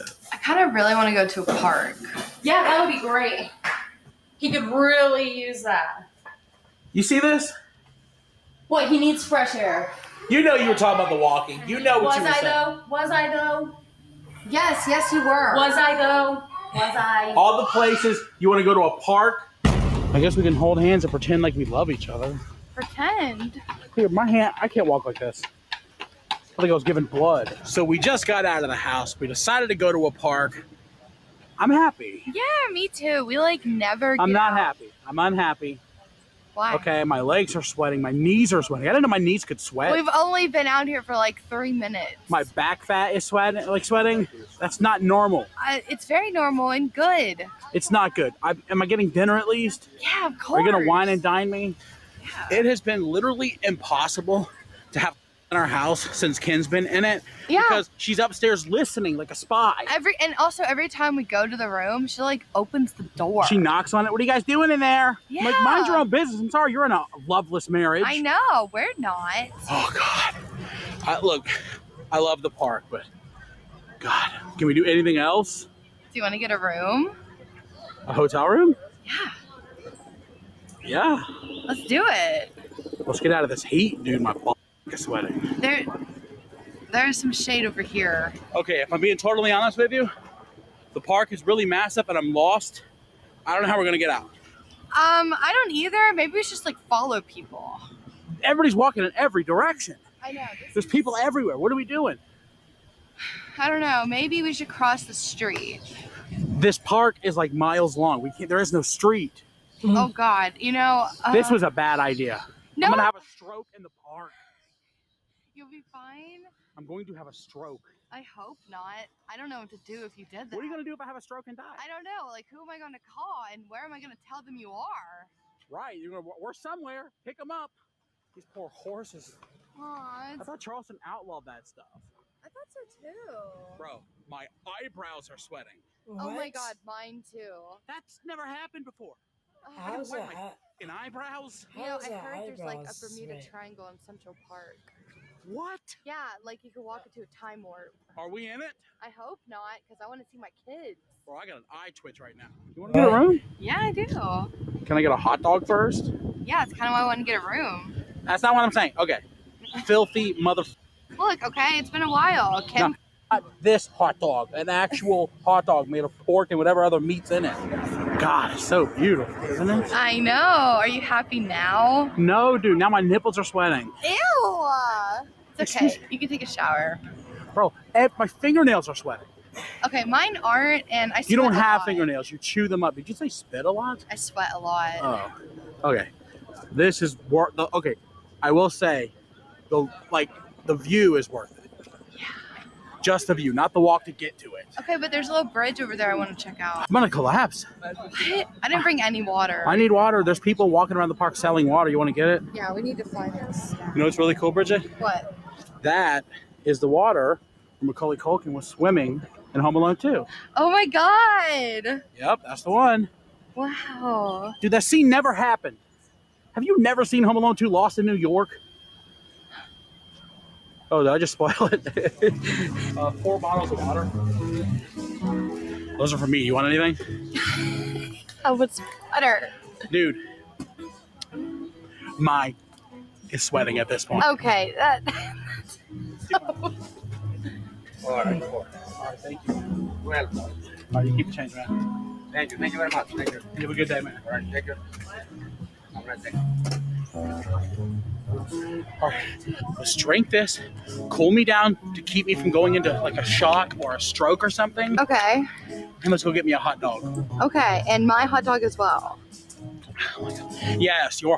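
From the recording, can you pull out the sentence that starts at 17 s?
All the places you want to go to a park.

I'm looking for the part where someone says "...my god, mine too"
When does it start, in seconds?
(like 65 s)
136 s.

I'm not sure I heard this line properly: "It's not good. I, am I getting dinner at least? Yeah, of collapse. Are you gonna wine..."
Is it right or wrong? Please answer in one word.
wrong.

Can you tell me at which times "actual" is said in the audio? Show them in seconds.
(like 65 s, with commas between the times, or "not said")
164 s.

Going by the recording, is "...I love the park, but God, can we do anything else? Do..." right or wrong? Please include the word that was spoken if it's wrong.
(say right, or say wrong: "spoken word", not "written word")
right.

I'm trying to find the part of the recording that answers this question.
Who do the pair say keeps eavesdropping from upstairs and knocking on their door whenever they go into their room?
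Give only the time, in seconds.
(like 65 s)
56 s.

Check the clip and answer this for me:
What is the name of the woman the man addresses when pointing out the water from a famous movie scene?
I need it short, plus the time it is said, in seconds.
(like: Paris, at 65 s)
Bridgette, at 204 s.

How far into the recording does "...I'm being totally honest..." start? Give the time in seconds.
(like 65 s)
88 s.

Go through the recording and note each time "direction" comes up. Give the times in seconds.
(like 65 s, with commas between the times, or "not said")
99 s.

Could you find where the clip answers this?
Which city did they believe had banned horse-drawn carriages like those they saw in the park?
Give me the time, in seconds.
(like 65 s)
130 s.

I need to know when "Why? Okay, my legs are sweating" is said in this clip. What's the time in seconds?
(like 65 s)
36 s.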